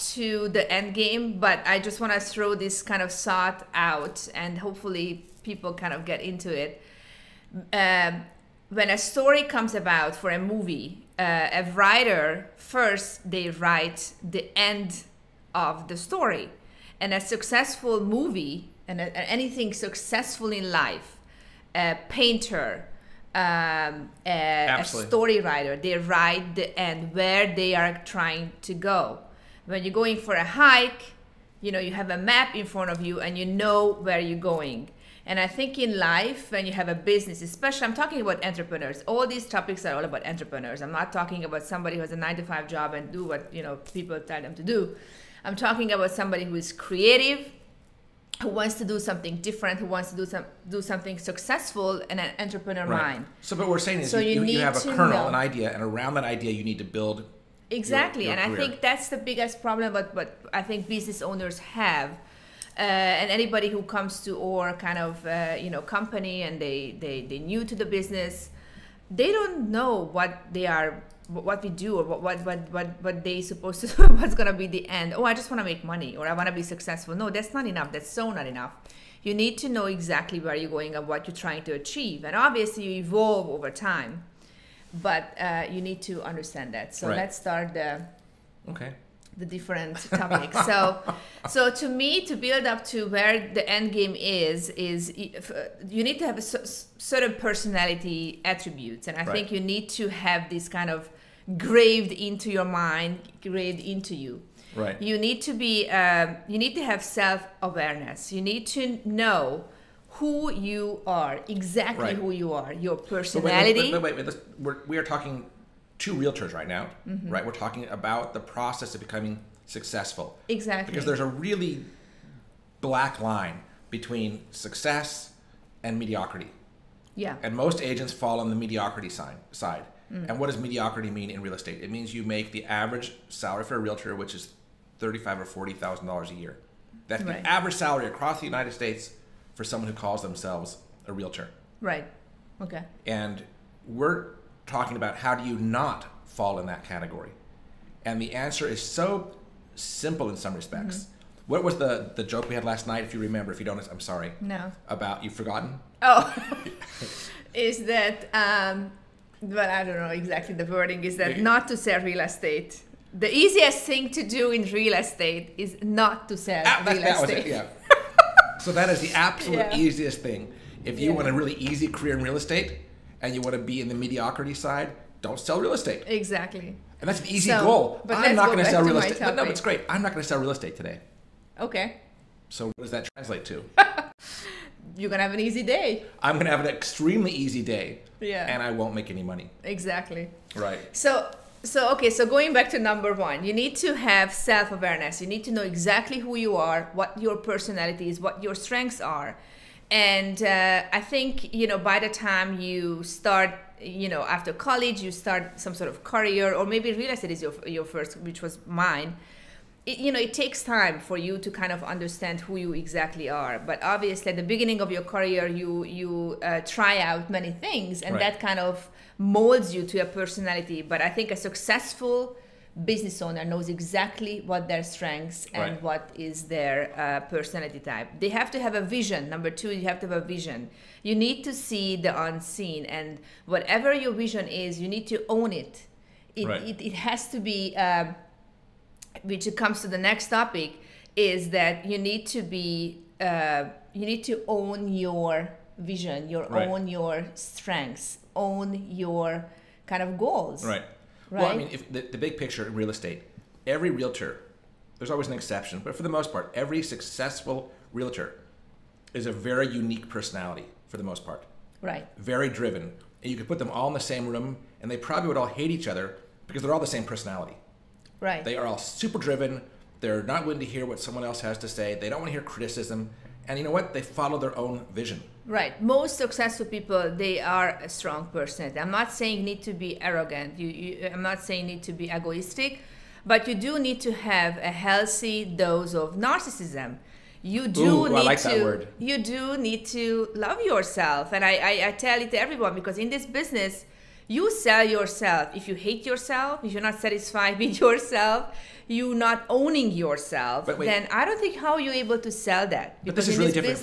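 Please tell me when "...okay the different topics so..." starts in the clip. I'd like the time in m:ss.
1:28.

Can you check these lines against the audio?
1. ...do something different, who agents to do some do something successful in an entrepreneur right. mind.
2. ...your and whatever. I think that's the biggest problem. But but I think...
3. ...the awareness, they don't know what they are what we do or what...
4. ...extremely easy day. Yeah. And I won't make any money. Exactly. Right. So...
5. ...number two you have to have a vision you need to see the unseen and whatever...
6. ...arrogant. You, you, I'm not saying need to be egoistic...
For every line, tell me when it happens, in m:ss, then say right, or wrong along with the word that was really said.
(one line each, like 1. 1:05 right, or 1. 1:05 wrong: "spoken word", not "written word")
1. 0:48 wrong: "wants", not "agents"
2. 0:58 wrong: "career", not "whatever"
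3. 1:07 wrong: "business", not "awareness"
4. 3:06 right
5. 3:49 right
6. 4:40 right.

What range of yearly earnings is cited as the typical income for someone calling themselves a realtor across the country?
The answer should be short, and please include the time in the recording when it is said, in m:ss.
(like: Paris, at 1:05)
$35,000 to $40,000, at 2:14.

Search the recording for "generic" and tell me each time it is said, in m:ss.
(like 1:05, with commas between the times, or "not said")
not said.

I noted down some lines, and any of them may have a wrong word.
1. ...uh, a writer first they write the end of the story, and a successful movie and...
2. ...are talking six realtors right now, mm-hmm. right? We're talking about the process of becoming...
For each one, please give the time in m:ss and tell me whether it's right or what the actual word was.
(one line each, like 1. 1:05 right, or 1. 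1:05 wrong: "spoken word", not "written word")
1. 0:11 right
2. 1:54 wrong: "two", not "six".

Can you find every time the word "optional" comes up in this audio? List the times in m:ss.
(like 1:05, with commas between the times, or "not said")
not said.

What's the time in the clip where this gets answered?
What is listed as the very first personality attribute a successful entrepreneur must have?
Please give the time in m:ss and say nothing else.
1:47.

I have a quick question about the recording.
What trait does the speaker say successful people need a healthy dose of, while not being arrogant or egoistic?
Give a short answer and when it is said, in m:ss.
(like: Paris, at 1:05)
Narcissism, at 4:46.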